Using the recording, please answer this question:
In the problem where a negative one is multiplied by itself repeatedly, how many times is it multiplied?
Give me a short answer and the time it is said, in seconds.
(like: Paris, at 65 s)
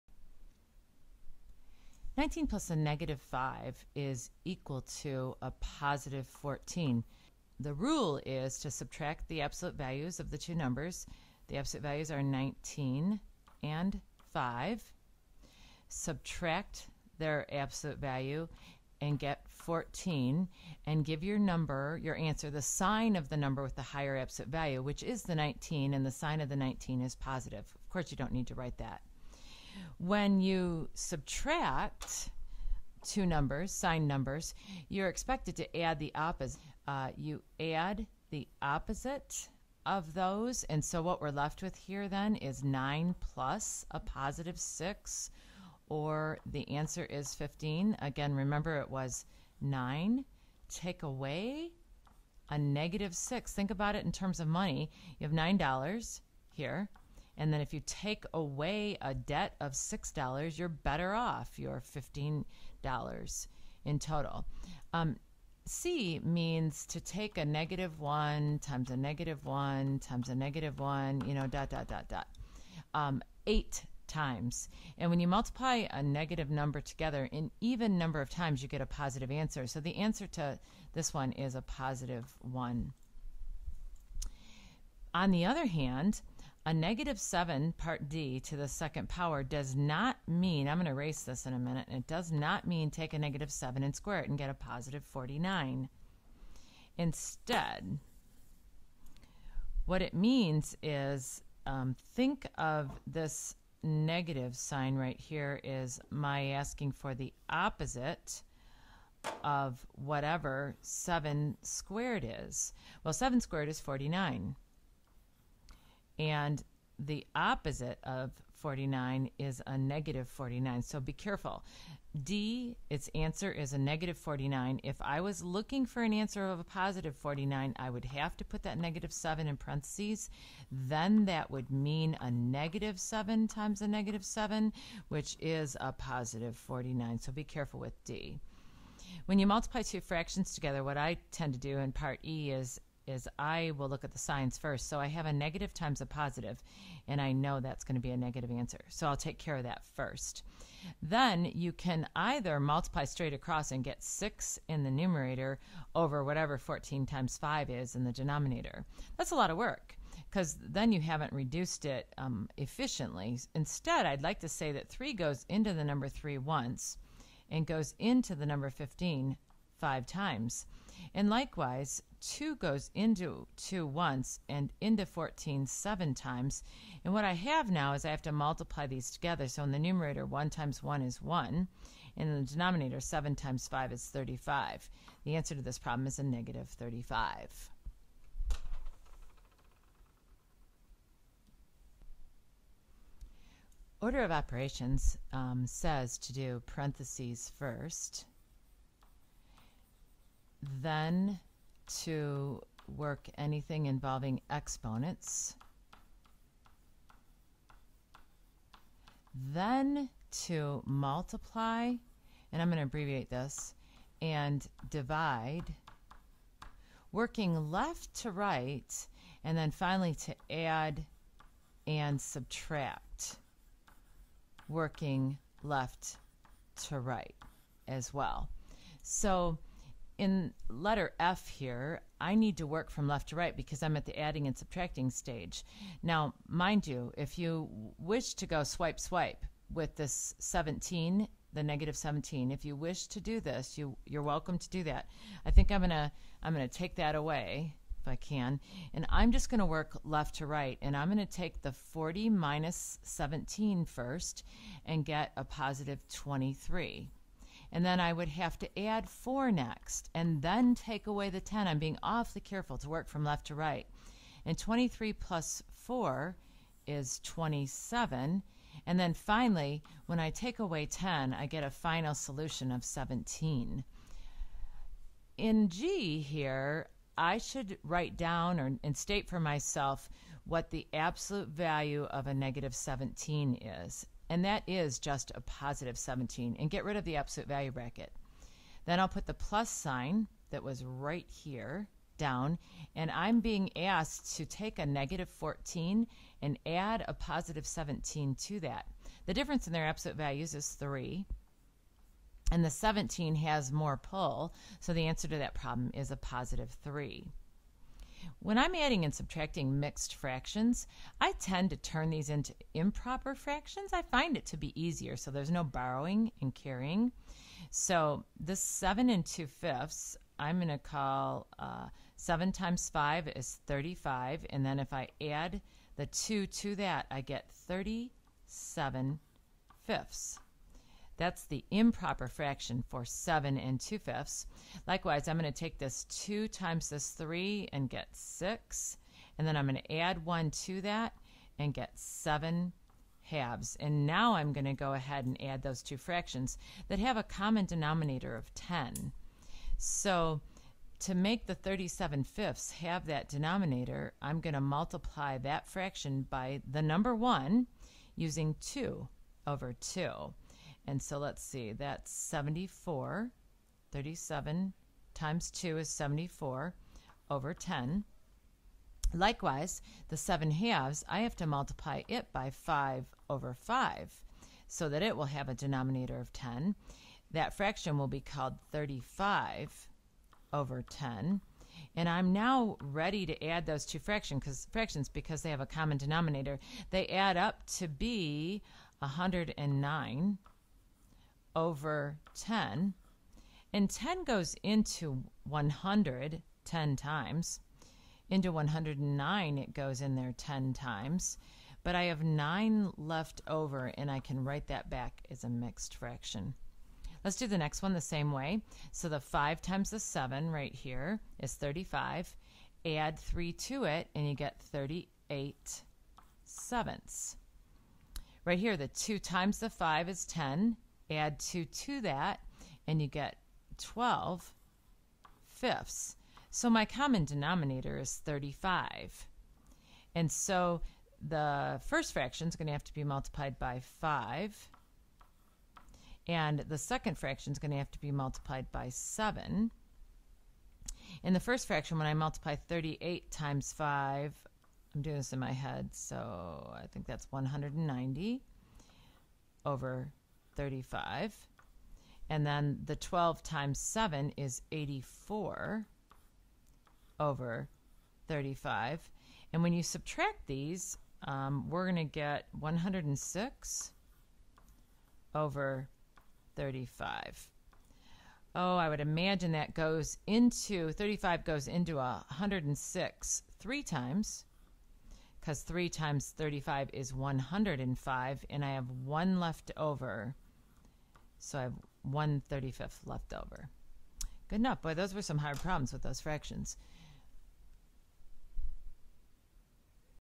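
8, at 73 s.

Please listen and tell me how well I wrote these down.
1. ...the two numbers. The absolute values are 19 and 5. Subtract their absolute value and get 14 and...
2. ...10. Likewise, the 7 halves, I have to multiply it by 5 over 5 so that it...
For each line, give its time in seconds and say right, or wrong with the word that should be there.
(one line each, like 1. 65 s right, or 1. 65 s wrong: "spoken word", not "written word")
1. 10 s right
2. 367 s right.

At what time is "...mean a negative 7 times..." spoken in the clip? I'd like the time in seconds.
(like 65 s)
131 s.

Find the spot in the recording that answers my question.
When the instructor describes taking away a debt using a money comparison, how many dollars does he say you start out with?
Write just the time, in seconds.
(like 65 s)
55 s.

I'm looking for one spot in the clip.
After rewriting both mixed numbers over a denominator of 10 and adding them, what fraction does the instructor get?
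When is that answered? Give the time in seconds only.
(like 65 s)
388 s.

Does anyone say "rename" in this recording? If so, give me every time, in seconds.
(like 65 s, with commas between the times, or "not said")
not said.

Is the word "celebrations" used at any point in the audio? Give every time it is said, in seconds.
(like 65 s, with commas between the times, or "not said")
not said.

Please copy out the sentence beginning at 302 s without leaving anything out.
And the 17 has more pull, so the answer to that problem is a positive 3.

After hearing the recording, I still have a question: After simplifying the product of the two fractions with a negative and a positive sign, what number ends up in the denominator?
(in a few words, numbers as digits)
35.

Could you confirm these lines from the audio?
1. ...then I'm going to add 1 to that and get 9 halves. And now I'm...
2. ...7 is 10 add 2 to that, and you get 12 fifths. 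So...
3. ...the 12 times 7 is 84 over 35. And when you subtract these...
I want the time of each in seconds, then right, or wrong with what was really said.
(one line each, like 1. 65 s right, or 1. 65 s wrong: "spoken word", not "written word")
1. 339 s wrong: "7", not "9"
2. 419 s wrong: "5", not "7"
3. 452 s right.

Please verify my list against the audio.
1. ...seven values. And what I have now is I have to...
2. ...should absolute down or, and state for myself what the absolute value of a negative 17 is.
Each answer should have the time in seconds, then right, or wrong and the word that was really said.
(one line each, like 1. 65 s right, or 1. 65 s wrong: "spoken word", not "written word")
1. 175 s wrong: "times", not "values"
2. 277 s wrong: "write", not "absolute".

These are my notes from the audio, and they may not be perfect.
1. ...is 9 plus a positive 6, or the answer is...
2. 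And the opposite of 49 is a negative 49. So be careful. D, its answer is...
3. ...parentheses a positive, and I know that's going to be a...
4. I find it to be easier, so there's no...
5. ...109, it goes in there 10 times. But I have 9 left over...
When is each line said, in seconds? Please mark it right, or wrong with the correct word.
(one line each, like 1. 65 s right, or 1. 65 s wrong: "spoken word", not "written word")
1. 42 s right
2. 116 s right
3. 145 s wrong: "times", not "parentheses"
4. 313 s right
5. 398 s right.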